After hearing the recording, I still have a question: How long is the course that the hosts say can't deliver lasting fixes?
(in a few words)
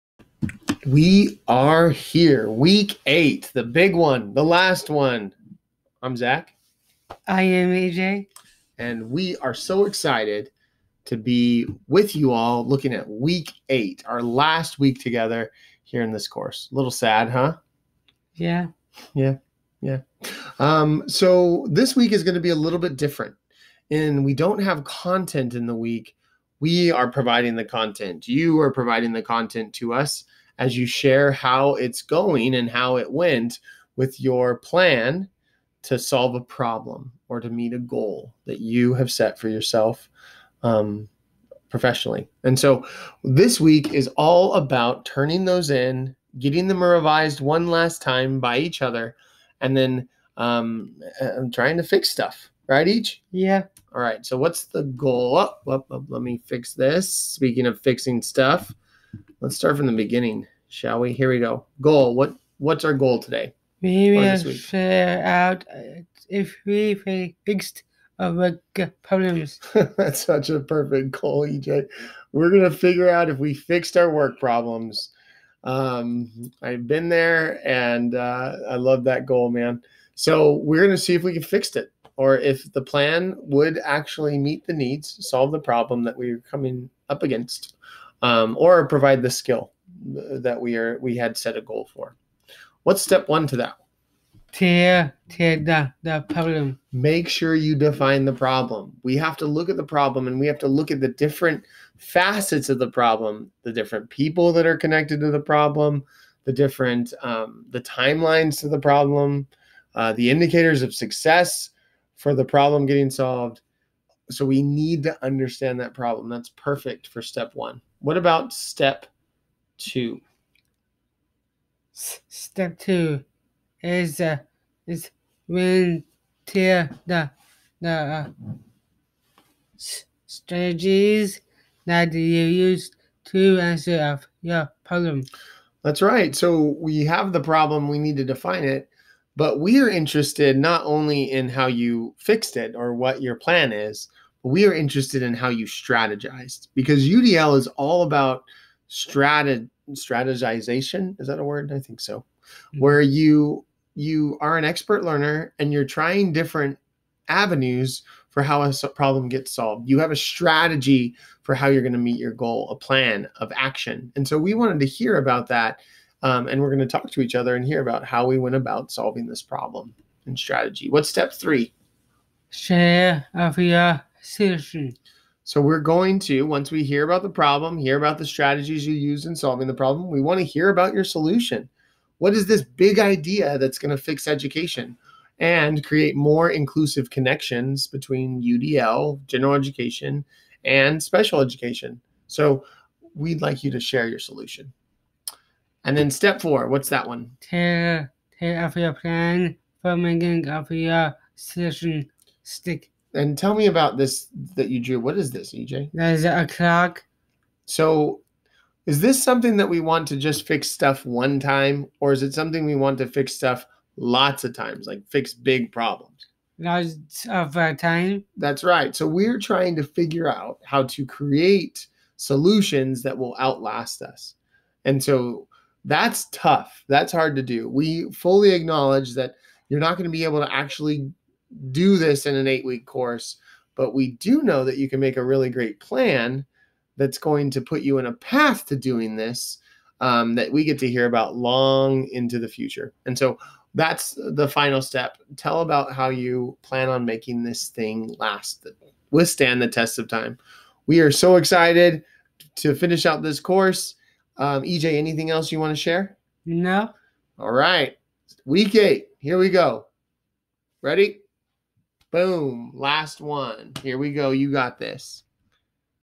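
8 weeks.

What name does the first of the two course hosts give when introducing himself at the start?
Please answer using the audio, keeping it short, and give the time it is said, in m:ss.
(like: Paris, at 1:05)
Zach, at 0:06.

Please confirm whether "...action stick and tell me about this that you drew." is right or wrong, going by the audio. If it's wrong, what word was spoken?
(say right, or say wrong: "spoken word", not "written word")
wrong: "session", not "action".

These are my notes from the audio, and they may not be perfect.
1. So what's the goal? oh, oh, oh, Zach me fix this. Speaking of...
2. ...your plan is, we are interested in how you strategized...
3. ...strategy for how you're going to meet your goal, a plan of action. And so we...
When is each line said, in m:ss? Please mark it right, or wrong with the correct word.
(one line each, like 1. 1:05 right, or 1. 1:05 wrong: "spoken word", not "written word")
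1. 0:54 wrong: "Let", not "Zach"
2. 2:23 right
3. 2:40 right.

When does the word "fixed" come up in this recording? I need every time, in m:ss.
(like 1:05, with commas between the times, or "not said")
1:07, 1:13, 2:22.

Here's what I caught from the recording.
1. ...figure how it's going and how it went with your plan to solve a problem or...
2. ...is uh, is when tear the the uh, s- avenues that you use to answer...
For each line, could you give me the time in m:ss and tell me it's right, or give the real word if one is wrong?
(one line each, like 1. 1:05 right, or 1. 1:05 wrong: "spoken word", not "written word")
1. 0:30 wrong: "share", not "figure"
2. 2:03 wrong: "strategies", not "avenues".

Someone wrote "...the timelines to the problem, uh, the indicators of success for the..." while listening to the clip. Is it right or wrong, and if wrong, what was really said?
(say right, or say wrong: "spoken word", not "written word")
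right.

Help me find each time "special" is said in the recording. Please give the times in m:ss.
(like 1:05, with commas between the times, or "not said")
3:11.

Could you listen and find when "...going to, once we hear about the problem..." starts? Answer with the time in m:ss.
2:55.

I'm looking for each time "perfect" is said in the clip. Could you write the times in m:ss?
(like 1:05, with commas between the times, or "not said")
1:10, 1:56.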